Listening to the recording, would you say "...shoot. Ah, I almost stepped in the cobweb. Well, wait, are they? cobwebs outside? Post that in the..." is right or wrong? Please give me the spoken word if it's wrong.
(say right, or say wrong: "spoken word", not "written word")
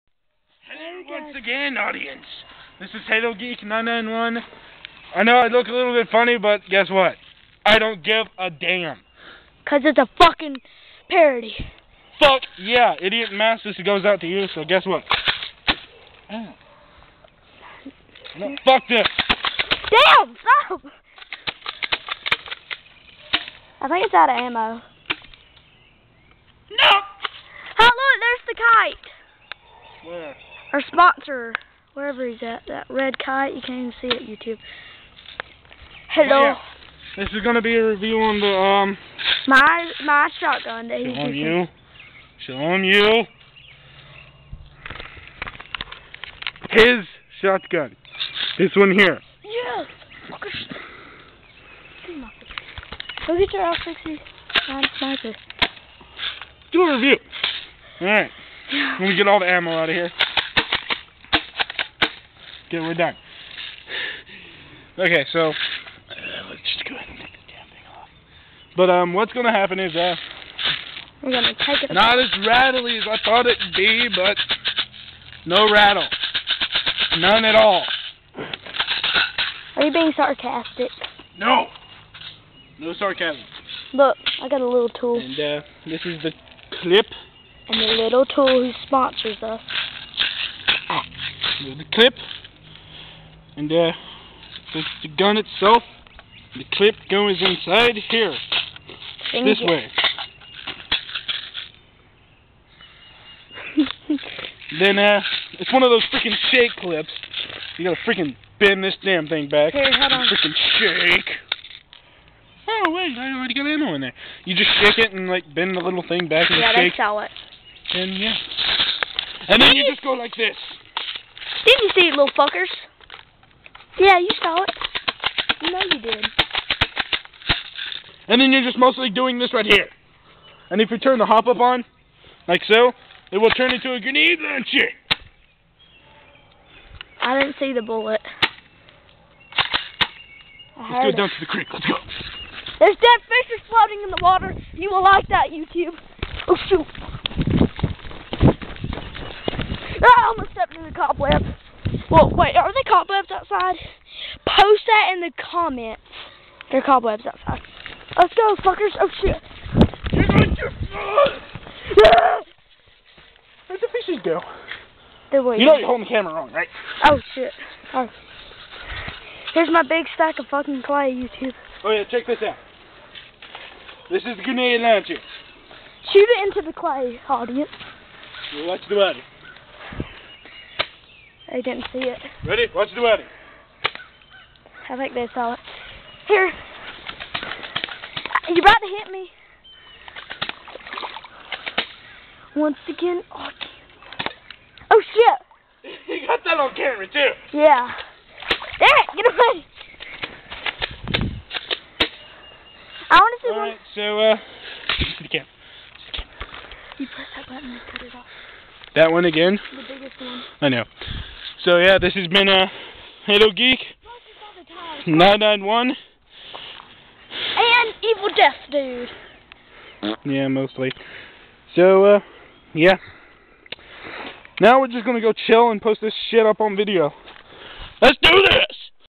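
right.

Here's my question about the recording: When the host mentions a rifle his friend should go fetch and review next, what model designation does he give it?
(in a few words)
L69 sniper.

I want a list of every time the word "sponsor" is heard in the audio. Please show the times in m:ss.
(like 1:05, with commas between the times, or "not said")
0:30, 1:28.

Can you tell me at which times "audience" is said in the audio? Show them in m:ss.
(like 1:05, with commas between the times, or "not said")
0:01, 2:57.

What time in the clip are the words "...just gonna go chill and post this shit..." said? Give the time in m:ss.
3:44.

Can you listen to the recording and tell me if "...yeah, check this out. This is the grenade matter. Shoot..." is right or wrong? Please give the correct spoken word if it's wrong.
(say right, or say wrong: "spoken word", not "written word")
wrong: "launcher", not "matter".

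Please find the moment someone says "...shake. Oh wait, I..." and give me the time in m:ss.
1:50.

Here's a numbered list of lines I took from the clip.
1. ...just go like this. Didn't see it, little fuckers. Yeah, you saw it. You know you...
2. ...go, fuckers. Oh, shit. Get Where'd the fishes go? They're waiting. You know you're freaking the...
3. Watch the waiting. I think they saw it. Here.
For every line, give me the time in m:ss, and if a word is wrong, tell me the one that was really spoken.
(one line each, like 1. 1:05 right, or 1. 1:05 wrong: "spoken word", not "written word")
1. 1:59 right
2. 2:38 wrong: "holding", not "freaking"
3. 3:02 wrong: "wedding", not "waiting".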